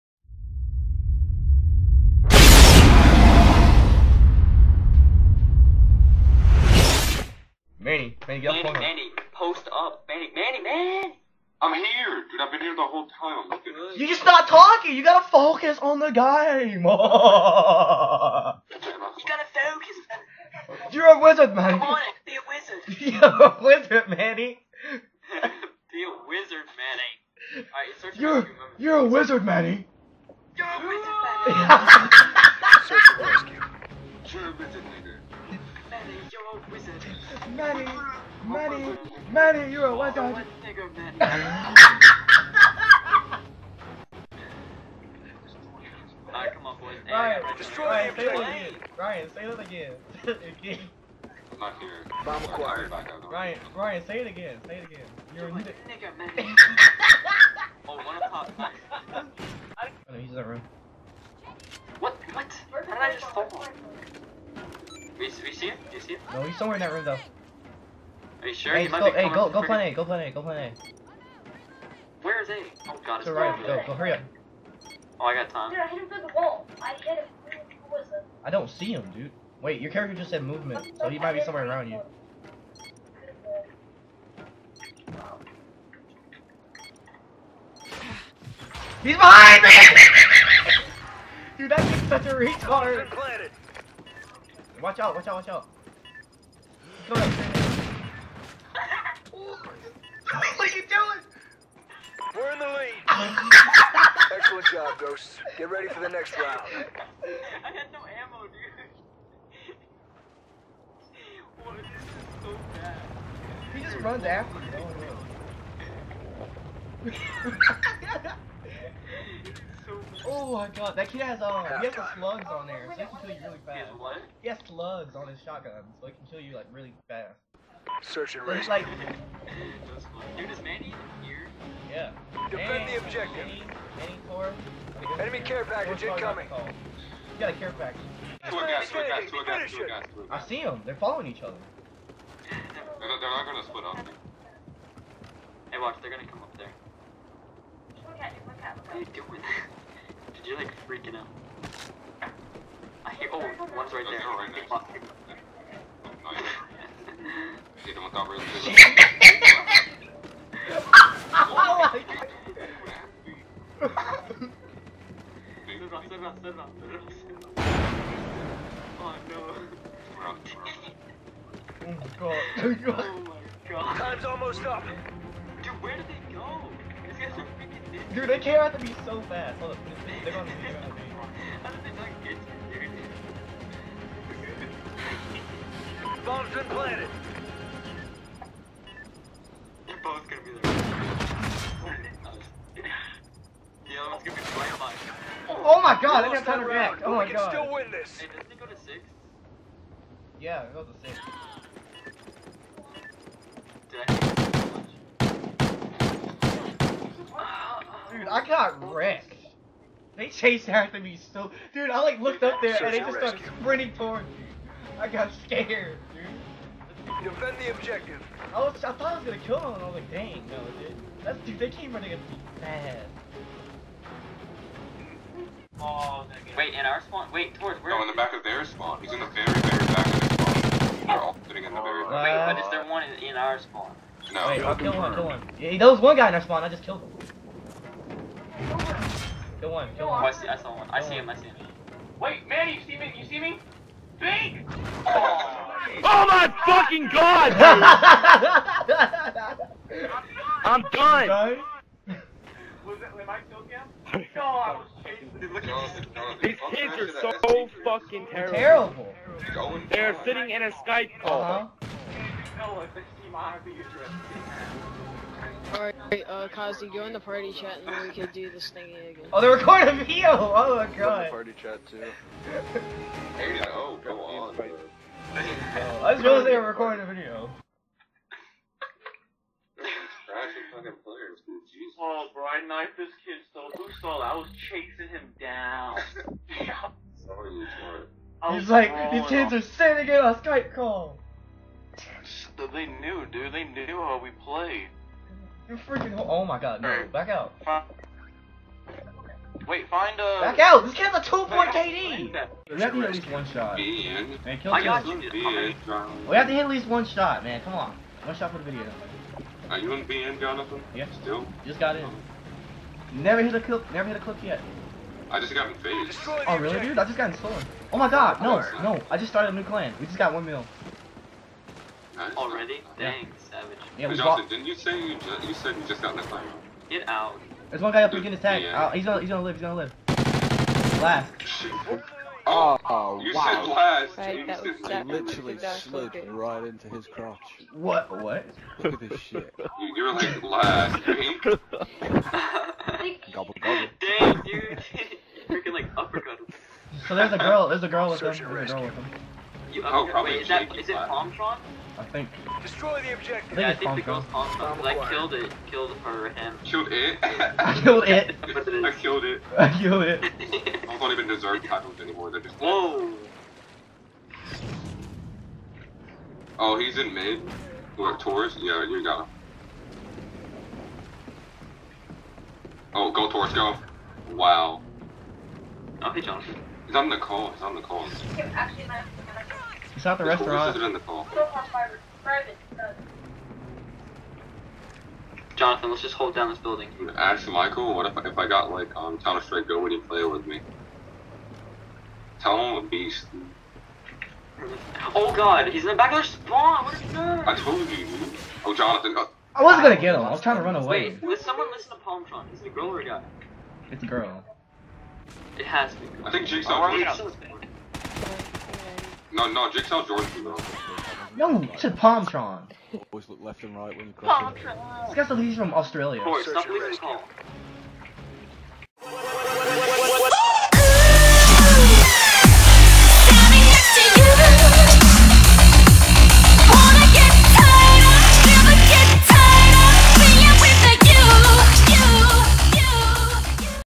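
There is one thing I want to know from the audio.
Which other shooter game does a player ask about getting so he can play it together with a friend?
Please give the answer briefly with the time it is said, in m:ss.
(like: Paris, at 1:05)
Counter Strike Go, at 6:29.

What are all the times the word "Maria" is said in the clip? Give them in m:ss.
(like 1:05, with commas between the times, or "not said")
not said.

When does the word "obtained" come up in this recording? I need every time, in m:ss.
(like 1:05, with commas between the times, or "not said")
not said.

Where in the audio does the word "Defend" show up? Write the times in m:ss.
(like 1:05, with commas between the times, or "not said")
2:12, 3:37.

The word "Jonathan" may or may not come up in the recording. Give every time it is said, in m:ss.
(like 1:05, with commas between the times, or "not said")
5:10, 6:16, 6:25, 6:38.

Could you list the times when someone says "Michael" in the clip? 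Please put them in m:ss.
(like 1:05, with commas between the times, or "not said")
6:27.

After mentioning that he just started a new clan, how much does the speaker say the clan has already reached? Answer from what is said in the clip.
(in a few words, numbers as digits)
1 mil.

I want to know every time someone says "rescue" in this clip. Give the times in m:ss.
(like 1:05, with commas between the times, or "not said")
0:33, 2:08.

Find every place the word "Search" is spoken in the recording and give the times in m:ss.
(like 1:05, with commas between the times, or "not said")
0:32, 2:08, 5:48.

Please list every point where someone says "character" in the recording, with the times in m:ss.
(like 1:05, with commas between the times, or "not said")
1:19.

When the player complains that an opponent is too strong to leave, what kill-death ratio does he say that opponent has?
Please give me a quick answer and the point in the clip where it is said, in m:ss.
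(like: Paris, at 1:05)
2, at 5:01.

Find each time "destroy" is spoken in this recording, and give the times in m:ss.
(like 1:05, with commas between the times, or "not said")
0:47, 5:52.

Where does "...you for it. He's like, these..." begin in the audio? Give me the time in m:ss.
4:47.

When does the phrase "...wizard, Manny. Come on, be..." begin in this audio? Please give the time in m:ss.
0:21.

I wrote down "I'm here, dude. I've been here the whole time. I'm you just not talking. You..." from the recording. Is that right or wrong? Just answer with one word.
right.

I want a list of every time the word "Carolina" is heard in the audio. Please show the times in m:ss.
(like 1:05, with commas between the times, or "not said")
not said.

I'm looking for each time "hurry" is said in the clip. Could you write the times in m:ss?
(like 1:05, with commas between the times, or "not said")
1:13.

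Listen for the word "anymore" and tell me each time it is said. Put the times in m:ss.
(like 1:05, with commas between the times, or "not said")
6:02.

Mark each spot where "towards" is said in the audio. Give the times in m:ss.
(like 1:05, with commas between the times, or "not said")
3:33, 3:47.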